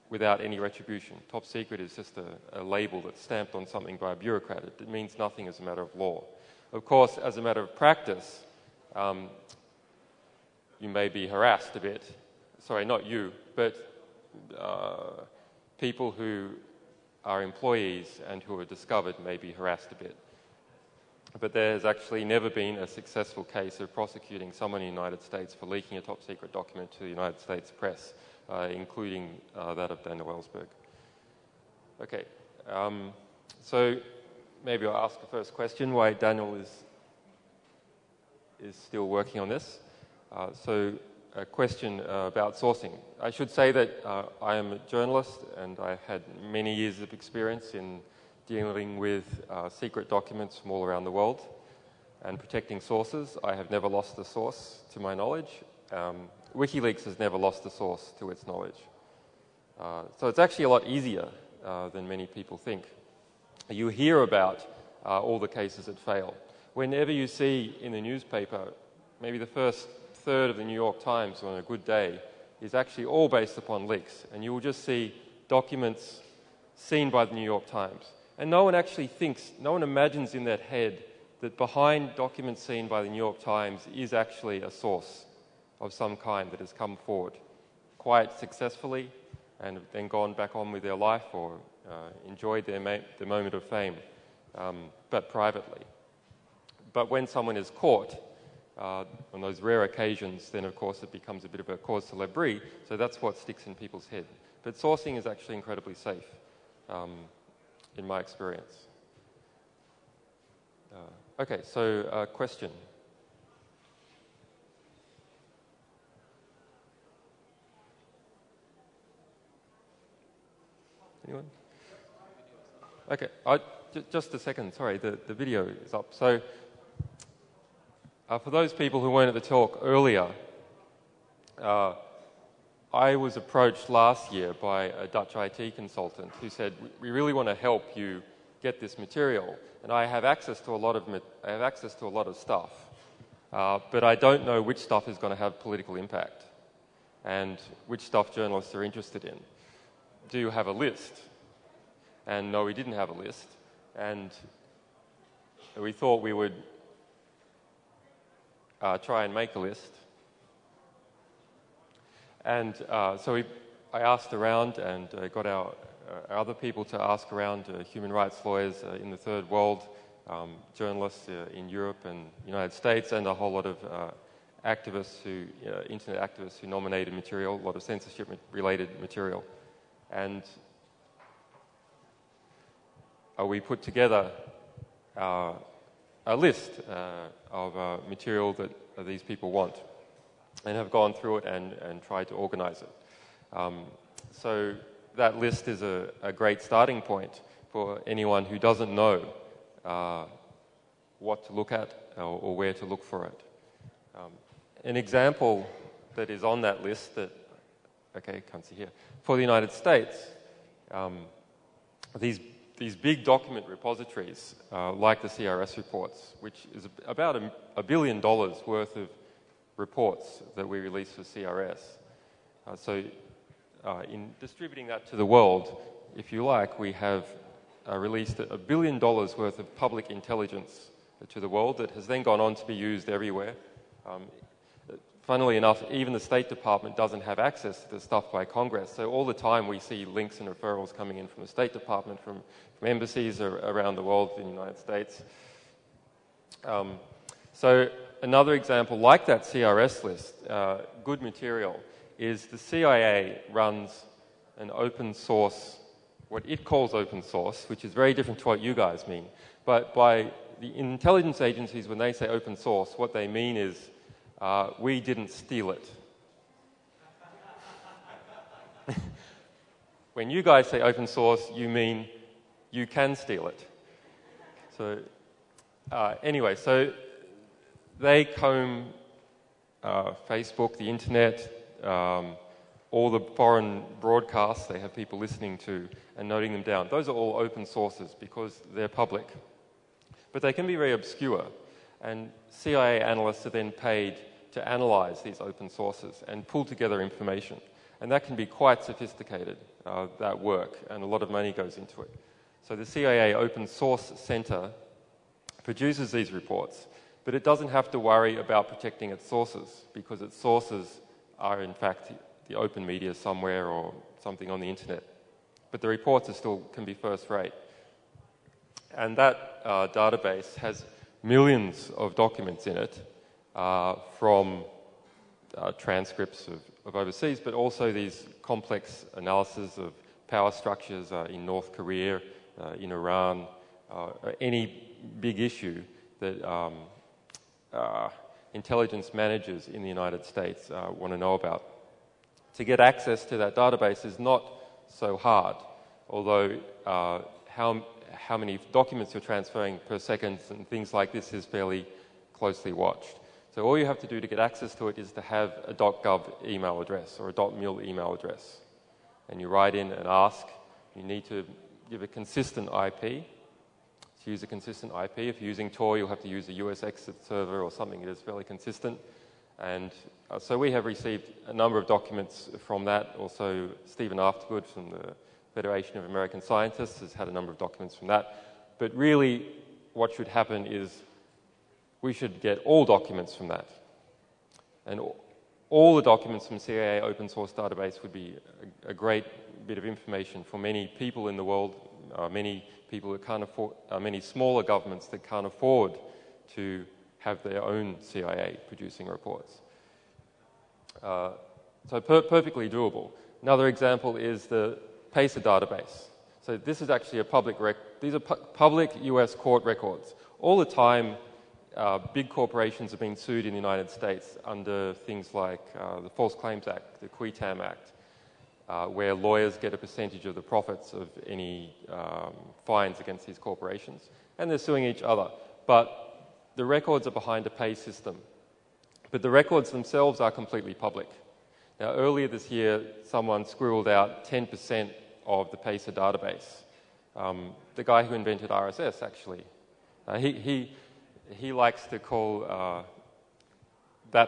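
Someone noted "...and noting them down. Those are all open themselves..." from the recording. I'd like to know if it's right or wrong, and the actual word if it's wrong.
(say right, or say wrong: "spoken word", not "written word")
wrong: "sources", not "themselves".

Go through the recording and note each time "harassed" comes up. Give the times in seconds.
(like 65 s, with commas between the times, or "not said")
11 s, 19 s.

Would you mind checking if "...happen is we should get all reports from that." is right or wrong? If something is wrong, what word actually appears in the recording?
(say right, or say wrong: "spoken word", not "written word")
wrong: "documents", not "reports".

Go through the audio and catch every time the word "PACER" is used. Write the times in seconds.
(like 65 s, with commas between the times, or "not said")
405 s, 435 s.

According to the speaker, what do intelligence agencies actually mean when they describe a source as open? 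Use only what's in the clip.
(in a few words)
We didn't steal it.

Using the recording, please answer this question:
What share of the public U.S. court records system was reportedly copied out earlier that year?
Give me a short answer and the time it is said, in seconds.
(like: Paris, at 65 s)
10%, at 434 s.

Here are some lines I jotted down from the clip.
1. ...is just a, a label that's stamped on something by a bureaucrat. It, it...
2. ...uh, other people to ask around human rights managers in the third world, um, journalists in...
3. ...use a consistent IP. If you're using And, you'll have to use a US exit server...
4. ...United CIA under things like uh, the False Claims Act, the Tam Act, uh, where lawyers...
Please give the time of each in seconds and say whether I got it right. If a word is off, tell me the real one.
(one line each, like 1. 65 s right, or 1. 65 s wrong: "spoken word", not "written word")
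1. 1 s right
2. 166 s wrong: "lawyers", not "managers"
3. 364 s wrong: "Tor", not "And"
4. 413 s wrong: "States", not "CIA".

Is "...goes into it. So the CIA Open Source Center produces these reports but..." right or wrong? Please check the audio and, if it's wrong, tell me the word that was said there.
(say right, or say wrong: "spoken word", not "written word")
right.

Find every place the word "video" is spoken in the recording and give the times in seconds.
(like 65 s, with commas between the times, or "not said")
125 s.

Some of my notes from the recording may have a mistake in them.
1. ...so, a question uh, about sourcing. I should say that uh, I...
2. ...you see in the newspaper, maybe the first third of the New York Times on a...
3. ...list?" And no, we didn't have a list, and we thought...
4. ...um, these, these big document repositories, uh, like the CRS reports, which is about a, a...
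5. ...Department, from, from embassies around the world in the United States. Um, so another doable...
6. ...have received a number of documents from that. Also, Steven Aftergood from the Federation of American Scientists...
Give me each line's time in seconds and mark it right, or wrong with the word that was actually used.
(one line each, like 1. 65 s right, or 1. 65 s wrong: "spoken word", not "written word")
1. 40 s right
2. 67 s right
3. 150 s right
4. 210 s right
5. 241 s wrong: "example", not "doable"
6. 370 s right.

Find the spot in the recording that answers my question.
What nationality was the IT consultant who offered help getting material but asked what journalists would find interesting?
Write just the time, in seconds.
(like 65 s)
135 s.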